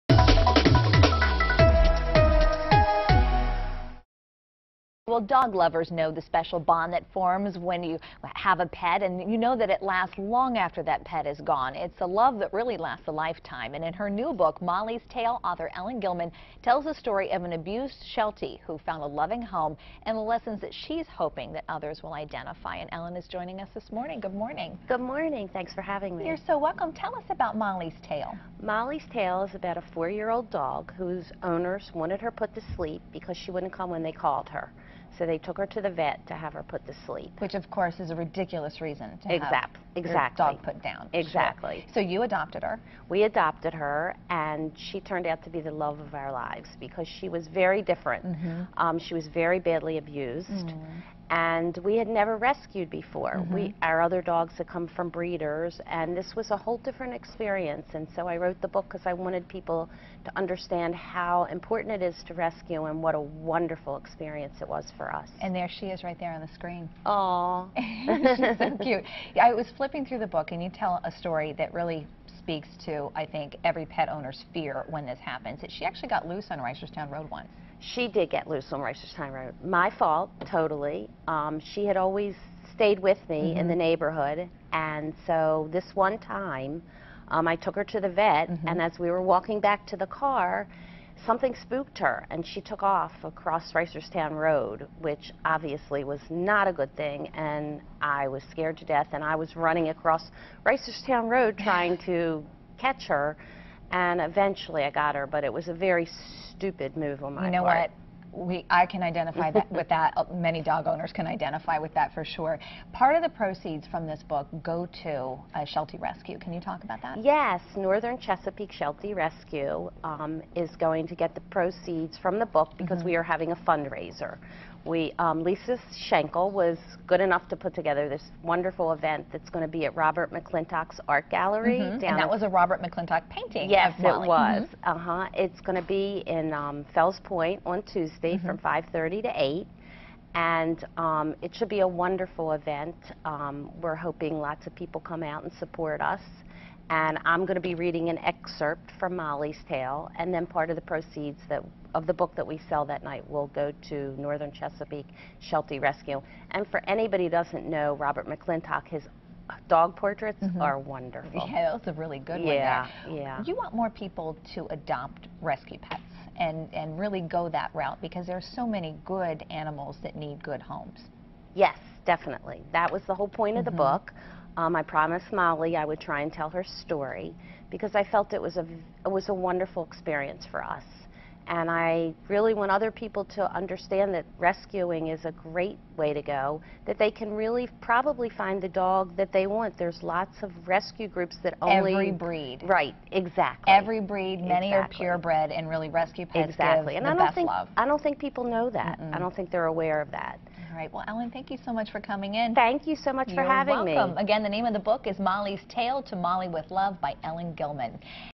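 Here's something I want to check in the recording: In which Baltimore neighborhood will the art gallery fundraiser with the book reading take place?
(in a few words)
Fells Point.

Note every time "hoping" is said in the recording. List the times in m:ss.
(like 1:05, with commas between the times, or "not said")
0:21, 2:24.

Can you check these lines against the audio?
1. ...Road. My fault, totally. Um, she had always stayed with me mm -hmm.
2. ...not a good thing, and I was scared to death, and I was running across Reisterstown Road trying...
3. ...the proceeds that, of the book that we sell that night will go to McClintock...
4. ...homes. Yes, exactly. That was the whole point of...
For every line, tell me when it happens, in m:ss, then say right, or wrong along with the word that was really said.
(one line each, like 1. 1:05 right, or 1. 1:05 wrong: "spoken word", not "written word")
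1. 1:19 right
2. 1:36 right
3. 2:30 wrong: "Northern", not "McClintock"
4. 2:50 wrong: "definitely", not "exactly".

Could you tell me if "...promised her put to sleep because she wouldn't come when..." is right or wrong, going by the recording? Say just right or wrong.
wrong.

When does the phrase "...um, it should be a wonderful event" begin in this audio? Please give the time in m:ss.
2:20.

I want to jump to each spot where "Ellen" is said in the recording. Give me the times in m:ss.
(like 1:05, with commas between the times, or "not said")
0:15, 0:22, 3:21, 3:27.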